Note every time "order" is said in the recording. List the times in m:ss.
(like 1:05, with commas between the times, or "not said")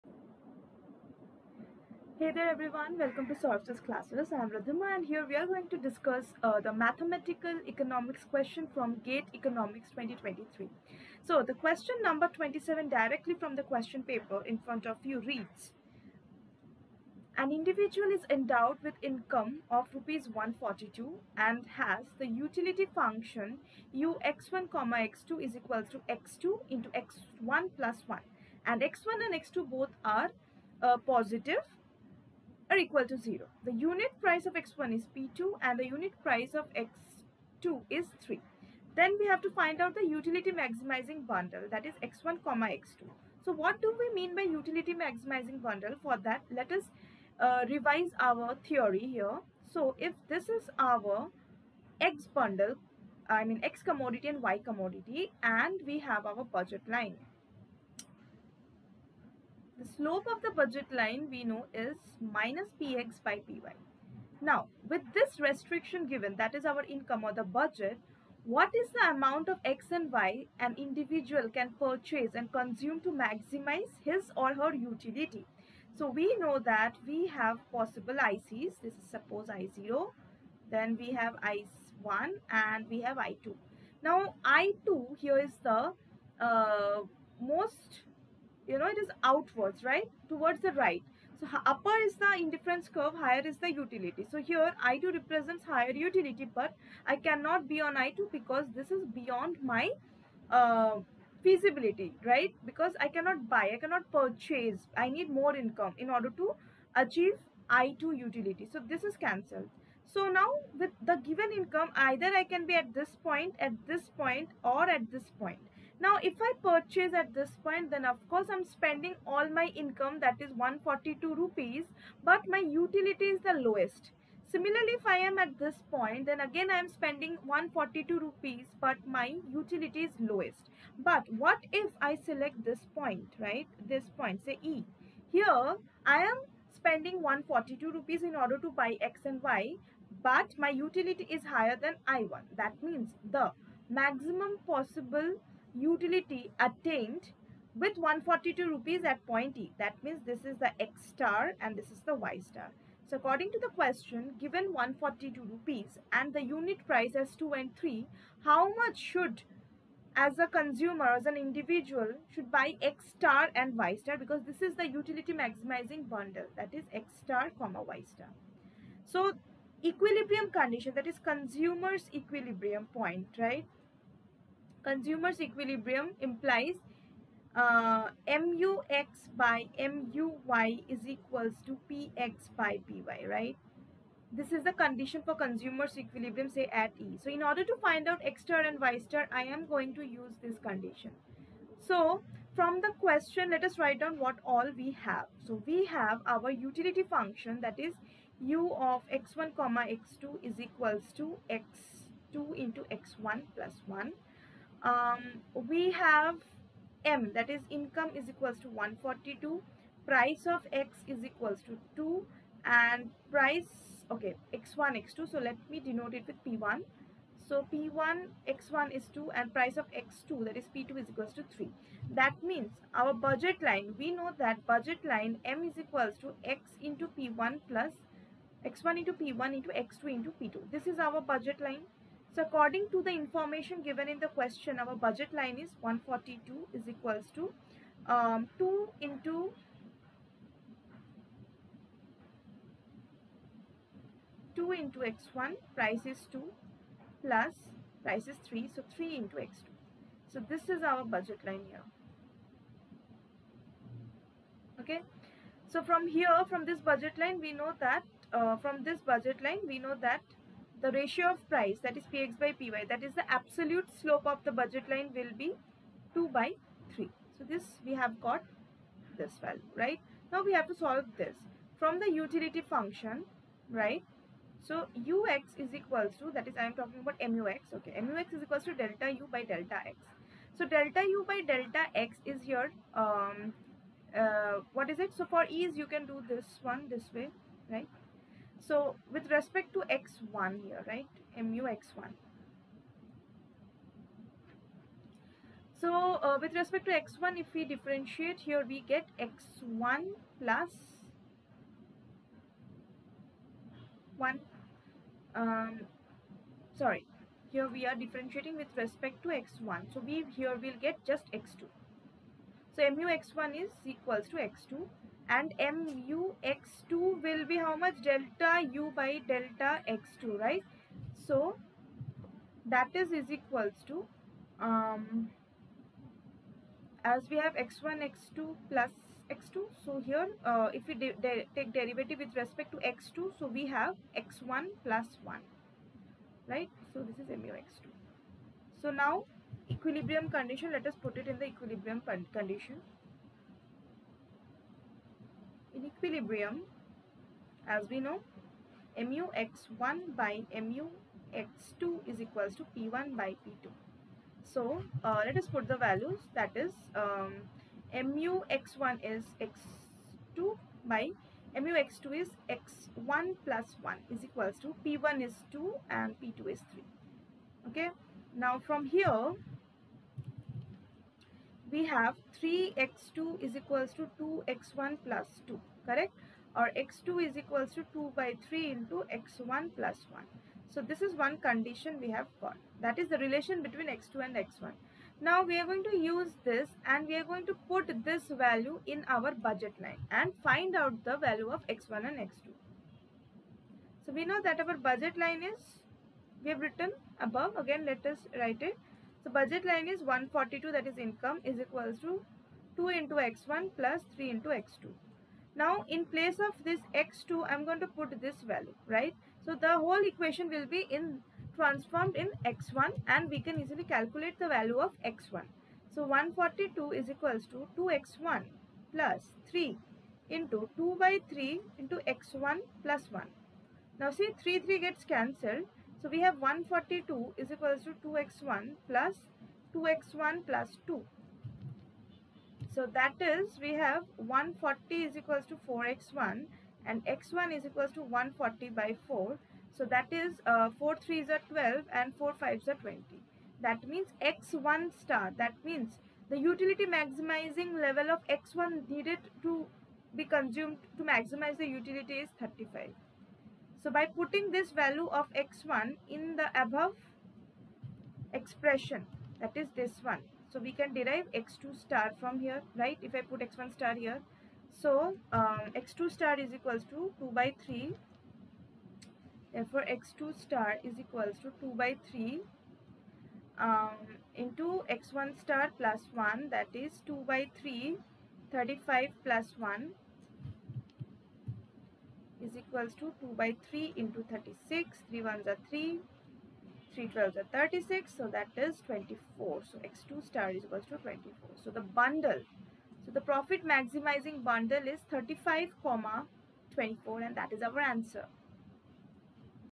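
1:46, 2:18, 3:07.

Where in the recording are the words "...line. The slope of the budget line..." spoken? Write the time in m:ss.
0:56.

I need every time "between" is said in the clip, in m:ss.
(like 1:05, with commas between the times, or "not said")
6:23.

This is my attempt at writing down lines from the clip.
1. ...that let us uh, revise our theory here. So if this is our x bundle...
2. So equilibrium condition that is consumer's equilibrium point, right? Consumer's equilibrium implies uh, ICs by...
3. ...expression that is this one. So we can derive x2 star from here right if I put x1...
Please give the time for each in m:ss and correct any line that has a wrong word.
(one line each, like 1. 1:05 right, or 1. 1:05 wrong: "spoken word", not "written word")
1. 0:46 right
2. 2:49 wrong: "MUX", not "ICs"
3. 7:38 right.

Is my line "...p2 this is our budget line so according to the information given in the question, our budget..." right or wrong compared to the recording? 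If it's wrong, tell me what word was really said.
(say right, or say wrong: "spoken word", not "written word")
right.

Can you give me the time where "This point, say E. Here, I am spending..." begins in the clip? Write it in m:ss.
2:13.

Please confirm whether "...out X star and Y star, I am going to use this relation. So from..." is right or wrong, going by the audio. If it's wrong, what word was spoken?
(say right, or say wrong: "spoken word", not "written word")
wrong: "condition", not "relation".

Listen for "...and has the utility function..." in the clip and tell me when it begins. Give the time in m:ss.
0:21.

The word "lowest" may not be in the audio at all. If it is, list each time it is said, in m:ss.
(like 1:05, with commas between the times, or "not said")
2:03, 2:10.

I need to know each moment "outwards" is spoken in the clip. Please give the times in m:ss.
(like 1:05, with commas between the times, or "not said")
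1:29.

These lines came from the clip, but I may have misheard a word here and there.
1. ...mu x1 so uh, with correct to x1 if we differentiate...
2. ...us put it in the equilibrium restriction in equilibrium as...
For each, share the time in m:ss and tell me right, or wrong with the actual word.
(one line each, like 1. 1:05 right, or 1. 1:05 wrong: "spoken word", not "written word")
1. 4:51 wrong: "respect", not "correct"
2. 5:40 wrong: "condition", not "restriction".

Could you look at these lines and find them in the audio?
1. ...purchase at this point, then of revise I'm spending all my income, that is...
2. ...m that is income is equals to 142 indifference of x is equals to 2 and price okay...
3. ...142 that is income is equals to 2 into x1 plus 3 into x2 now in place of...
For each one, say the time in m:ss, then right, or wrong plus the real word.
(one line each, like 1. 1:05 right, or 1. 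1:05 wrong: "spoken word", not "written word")
1. 1:56 wrong: "course", not "revise"
2. 3:27 wrong: "price", not "indifference"
3. 6:39 right.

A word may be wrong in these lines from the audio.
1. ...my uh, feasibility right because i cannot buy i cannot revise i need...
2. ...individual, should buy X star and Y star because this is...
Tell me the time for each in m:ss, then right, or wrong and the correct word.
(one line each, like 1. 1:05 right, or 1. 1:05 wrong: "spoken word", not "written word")
1. 1:39 wrong: "purchase", not "revise"
2. 2:41 right.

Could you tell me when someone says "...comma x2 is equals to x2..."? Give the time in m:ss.
3:19.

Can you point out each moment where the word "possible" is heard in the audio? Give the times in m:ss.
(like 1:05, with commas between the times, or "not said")
1:17, 2:24.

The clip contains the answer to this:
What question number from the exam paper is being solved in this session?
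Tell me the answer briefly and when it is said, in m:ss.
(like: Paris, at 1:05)
27, at 0:12.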